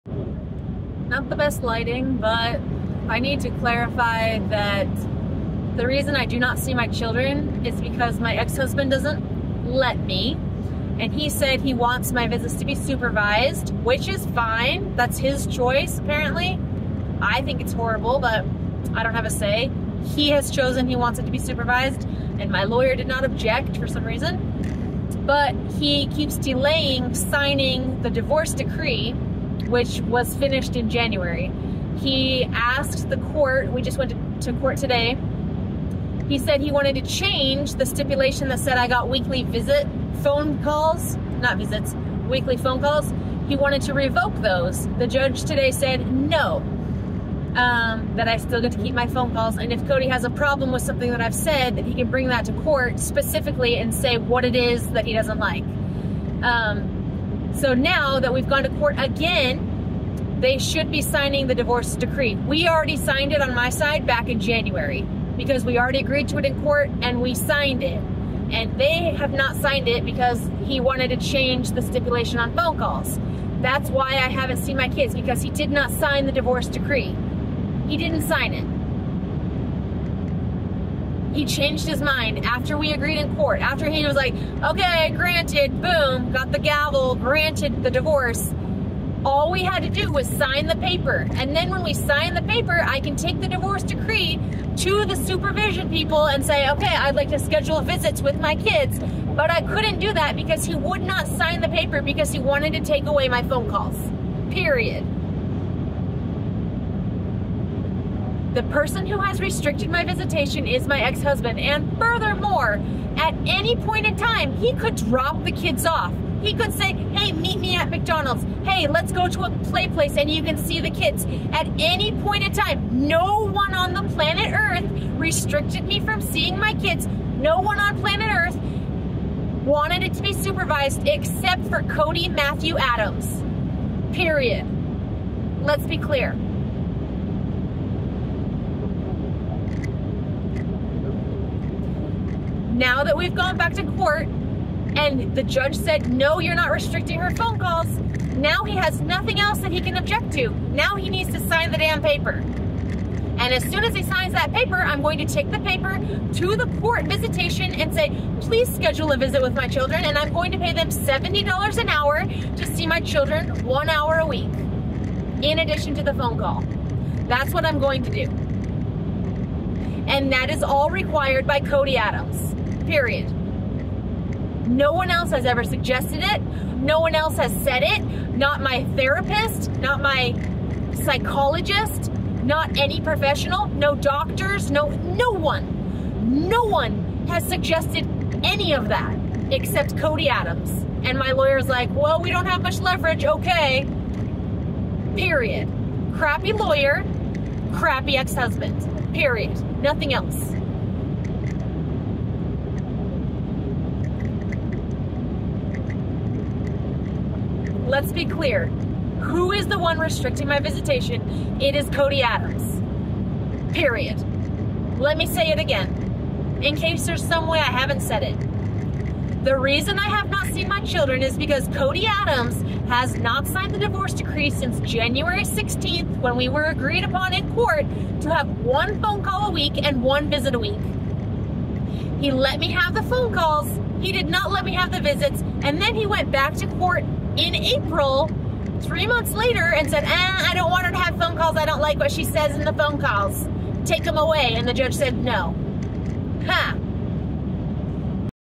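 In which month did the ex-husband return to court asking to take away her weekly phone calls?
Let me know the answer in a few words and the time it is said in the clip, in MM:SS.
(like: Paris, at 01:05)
April, at 03:57.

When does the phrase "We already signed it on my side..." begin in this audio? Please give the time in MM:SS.
01:02.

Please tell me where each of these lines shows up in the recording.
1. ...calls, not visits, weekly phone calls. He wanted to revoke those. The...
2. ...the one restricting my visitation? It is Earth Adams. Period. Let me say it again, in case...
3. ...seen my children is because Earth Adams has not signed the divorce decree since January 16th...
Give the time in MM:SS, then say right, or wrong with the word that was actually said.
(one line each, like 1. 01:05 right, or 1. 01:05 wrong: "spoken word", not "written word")
1. 00:40 right
2. 03:29 wrong: "Cody", not "Earth"
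3. 03:40 wrong: "Cody", not "Earth".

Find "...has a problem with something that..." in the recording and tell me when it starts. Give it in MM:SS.
00:50.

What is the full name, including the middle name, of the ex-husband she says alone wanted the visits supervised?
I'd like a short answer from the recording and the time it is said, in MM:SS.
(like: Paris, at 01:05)
Cody Matthew Adams, at 02:11.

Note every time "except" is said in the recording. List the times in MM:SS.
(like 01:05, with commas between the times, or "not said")
02:11, 03:09.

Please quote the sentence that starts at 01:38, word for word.
But I couldn't do that because he would not sign the paper because he wanted to take away my phone calls, period.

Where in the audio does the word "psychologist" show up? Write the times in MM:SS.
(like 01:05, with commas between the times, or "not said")
03:00.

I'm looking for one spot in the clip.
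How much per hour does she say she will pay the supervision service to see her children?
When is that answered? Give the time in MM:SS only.
02:40.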